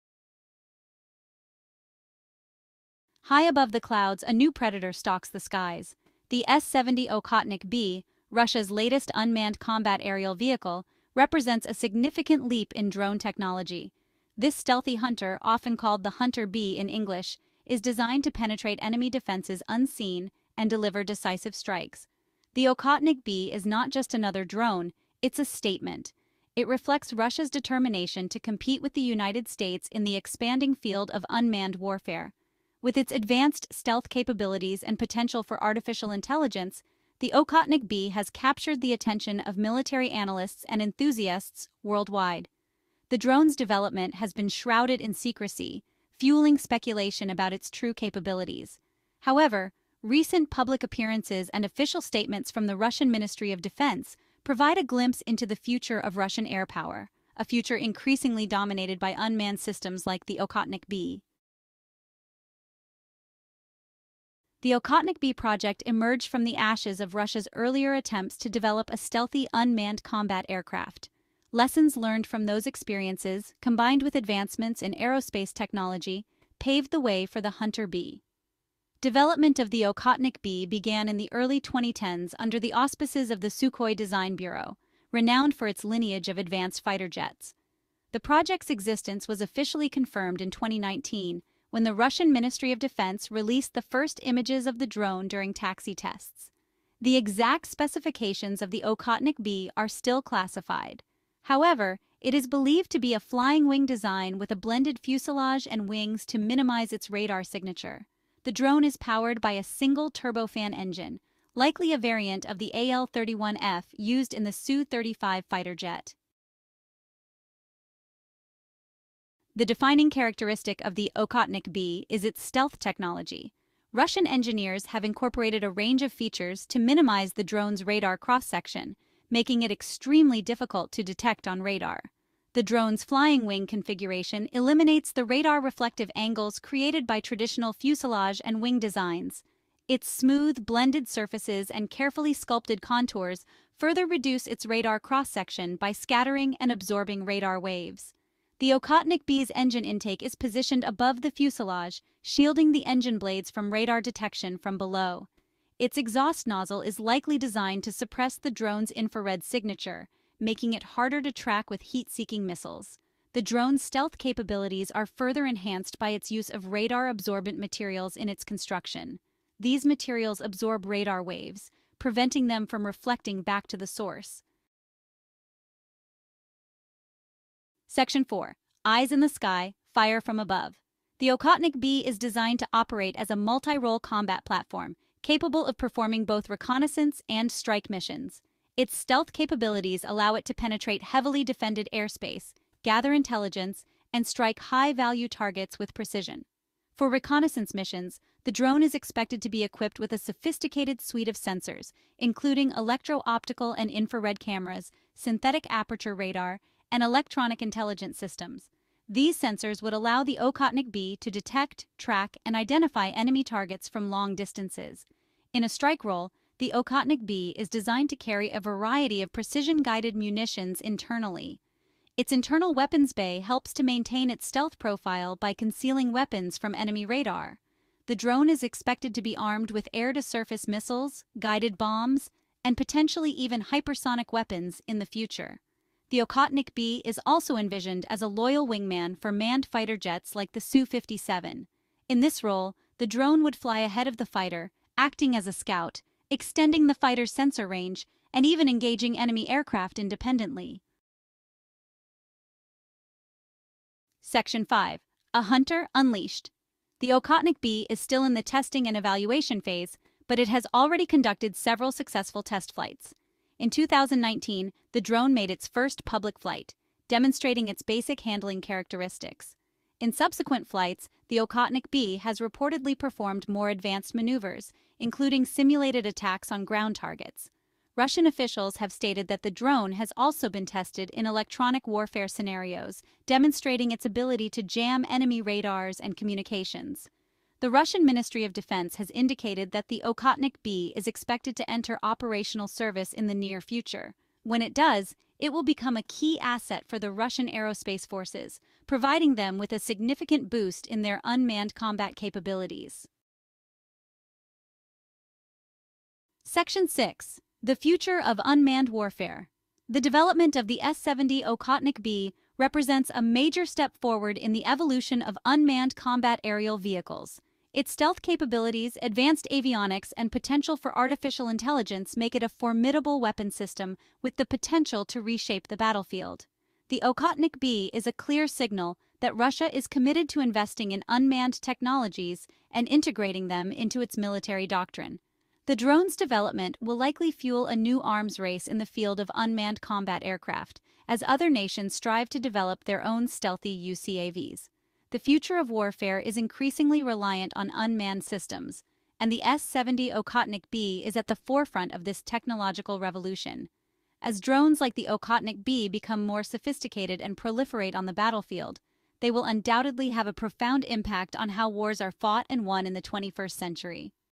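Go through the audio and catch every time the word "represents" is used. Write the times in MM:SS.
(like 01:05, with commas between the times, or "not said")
00:11, 05:12.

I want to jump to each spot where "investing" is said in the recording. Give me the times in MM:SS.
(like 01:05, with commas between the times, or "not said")
05:30.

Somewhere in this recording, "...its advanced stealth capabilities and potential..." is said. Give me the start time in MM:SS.
00:32.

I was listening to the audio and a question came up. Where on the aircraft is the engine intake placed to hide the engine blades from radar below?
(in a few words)
above the fuselage.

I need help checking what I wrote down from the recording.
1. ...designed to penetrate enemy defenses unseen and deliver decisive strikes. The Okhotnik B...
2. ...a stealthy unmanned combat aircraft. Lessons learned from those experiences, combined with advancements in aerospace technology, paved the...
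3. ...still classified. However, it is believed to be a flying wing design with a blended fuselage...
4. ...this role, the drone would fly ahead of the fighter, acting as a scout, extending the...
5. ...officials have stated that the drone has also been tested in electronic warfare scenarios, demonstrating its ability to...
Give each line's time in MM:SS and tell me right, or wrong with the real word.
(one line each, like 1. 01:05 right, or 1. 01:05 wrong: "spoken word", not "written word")
1. 00:17 right
2. 01:08 right
3. 01:39 right
4. 04:02 right
5. 04:38 right.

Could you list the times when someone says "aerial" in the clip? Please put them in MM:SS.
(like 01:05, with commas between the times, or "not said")
00:10, 05:16.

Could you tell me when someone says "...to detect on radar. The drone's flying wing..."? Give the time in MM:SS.
02:10.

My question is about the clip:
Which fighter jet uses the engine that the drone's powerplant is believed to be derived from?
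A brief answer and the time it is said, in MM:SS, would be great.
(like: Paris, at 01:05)
Su-35, at 01:54.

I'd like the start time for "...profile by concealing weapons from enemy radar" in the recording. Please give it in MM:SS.
03:44.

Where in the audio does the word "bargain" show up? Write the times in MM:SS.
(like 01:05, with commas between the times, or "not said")
not said.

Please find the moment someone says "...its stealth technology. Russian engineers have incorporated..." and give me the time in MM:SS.
02:02.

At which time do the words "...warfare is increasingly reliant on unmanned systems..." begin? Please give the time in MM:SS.
05:45.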